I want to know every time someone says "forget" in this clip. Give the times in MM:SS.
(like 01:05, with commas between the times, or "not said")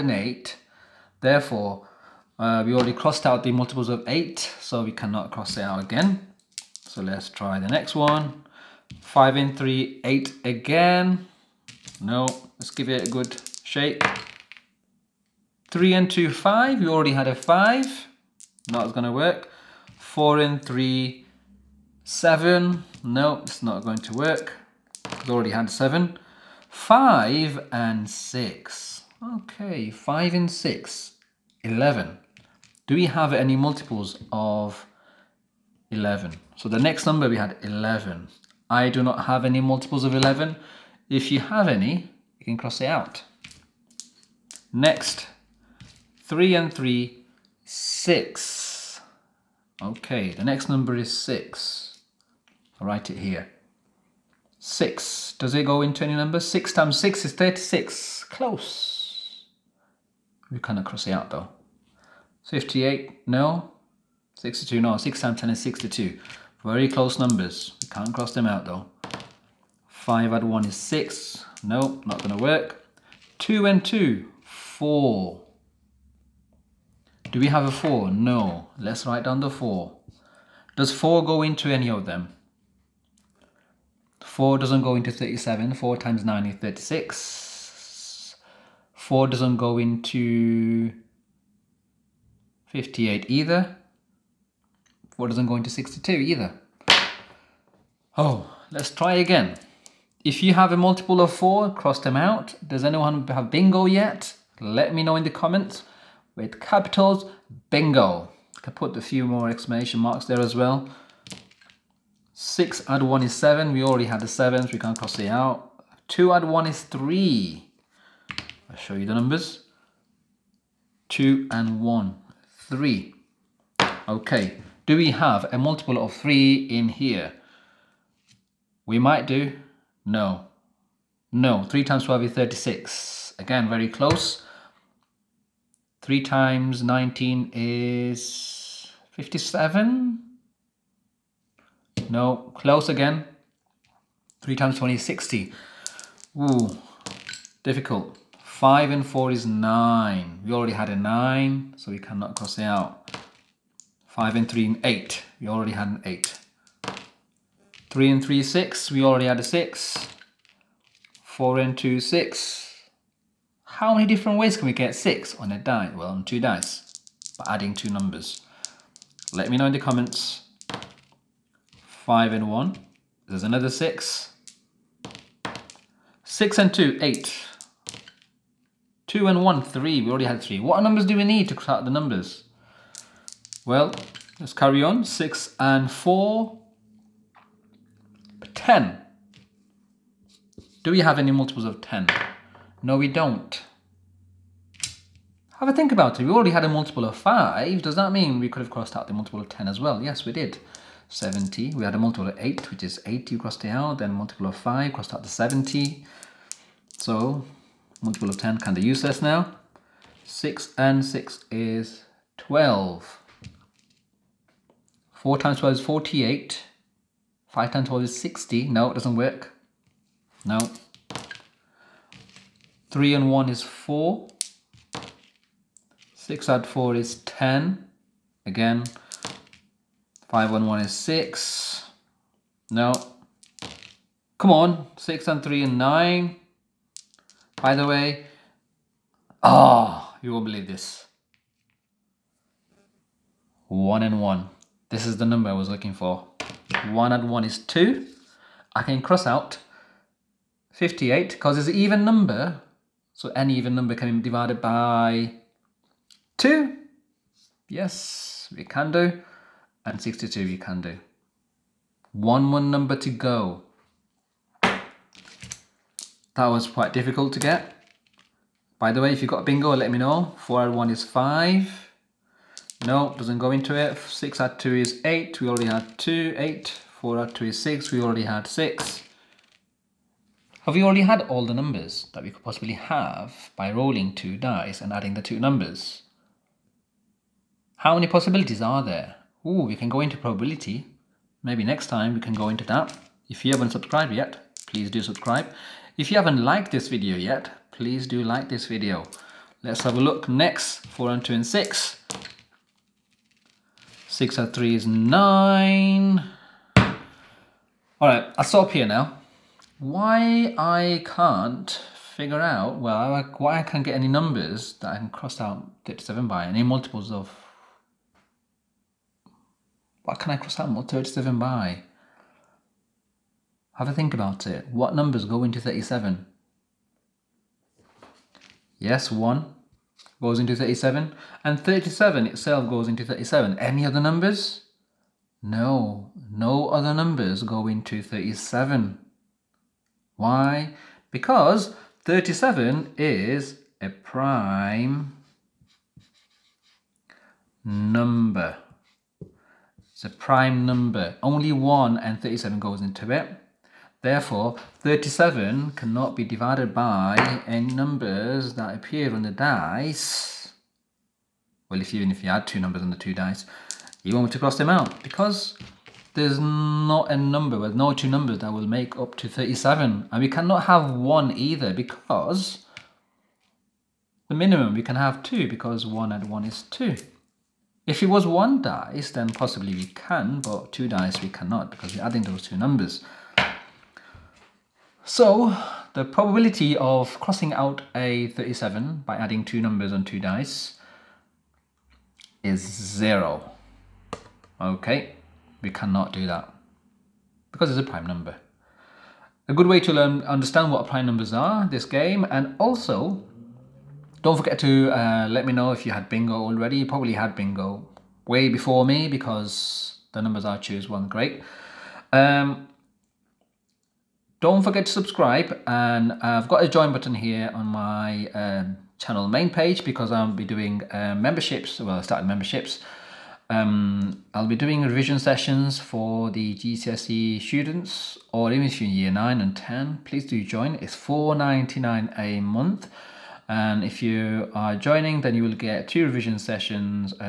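06:44, 06:54.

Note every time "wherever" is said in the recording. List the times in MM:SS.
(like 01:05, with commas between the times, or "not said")
not said.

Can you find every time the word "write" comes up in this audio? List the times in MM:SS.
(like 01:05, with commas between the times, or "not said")
00:52, 01:19.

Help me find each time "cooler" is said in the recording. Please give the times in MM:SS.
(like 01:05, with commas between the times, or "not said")
not said.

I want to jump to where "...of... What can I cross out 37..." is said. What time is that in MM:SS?
05:17.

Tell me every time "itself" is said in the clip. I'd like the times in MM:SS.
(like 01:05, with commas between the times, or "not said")
05:32.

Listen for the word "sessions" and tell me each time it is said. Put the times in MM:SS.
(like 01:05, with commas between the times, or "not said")
07:05, 07:16.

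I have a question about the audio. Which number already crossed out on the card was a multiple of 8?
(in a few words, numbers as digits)
80.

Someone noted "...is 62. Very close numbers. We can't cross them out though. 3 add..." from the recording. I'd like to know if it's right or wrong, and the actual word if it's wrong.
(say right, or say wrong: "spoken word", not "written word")
wrong: "5", not "3".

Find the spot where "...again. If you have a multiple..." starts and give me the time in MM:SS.
01:39.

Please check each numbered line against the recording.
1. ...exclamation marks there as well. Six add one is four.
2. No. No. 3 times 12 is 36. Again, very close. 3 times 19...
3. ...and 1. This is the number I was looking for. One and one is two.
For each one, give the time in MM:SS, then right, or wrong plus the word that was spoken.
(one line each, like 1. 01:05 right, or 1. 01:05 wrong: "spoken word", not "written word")
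1. 01:49 wrong: "seven", not "four"
2. 02:10 right
3. 04:04 right.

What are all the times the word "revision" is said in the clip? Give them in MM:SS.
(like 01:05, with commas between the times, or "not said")
07:04, 07:16.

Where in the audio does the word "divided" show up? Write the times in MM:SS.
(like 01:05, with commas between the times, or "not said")
04:14, 05:56.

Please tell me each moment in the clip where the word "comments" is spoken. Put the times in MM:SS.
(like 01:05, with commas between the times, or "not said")
01:45, 02:49.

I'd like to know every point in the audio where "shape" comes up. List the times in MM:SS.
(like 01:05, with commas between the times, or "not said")
not said.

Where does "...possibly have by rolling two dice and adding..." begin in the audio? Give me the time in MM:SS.
04:42.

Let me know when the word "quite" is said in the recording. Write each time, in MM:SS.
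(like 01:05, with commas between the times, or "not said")
04:26.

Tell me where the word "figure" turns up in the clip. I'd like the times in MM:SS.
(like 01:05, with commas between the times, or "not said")
05:12.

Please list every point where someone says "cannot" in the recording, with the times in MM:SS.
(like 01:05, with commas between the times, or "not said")
00:04, 01:00, 02:31, 05:55, 06:10, 06:21, 06:35.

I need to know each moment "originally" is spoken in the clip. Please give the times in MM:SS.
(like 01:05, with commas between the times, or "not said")
not said.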